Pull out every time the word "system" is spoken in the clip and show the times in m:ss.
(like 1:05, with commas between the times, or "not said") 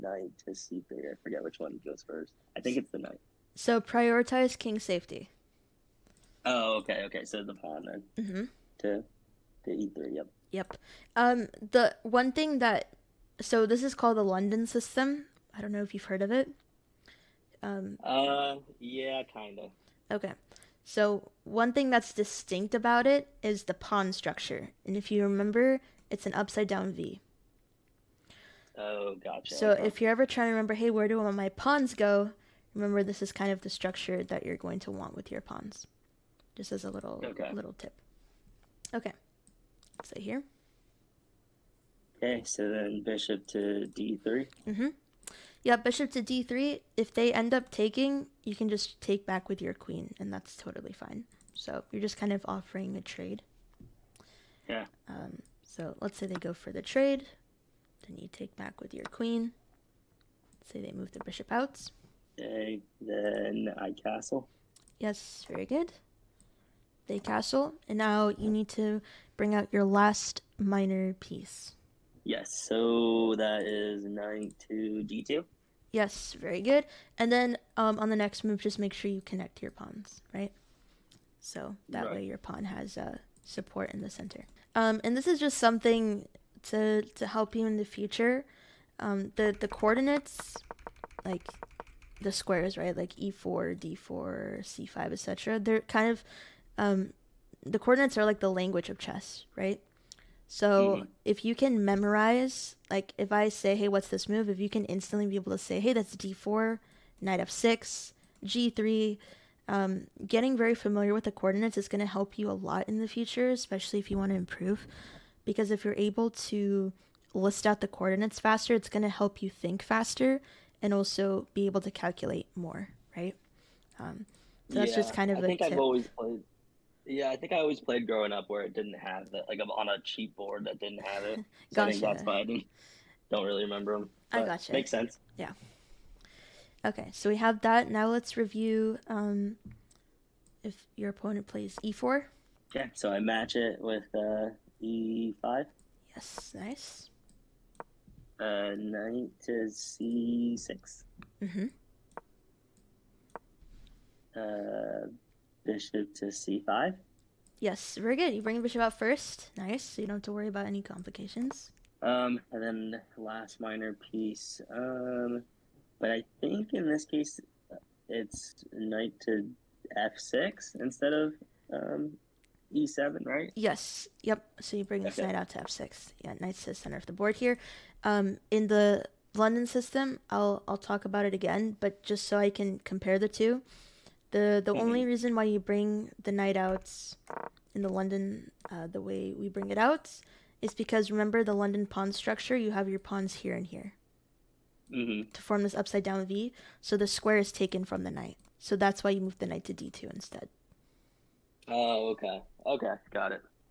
0:14, 2:59.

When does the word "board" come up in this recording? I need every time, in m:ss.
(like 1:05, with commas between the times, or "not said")
2:10, 2:57.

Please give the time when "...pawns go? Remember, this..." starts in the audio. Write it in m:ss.
0:31.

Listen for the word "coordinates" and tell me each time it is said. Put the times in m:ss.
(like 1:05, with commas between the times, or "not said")
1:29, 1:37, 1:51, 1:57.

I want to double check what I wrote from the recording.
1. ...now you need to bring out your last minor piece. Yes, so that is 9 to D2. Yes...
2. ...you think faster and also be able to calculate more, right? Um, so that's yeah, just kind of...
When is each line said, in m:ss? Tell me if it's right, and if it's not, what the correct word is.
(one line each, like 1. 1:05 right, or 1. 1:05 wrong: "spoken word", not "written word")
1. 1:07 right
2. 1:59 right.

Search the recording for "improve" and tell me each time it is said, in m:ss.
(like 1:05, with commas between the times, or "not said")
1:54.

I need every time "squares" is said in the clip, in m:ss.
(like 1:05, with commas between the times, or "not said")
1:32, 3:17.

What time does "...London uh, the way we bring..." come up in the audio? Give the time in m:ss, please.
3:07.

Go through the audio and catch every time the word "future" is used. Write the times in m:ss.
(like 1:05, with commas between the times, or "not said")
1:27, 1:53.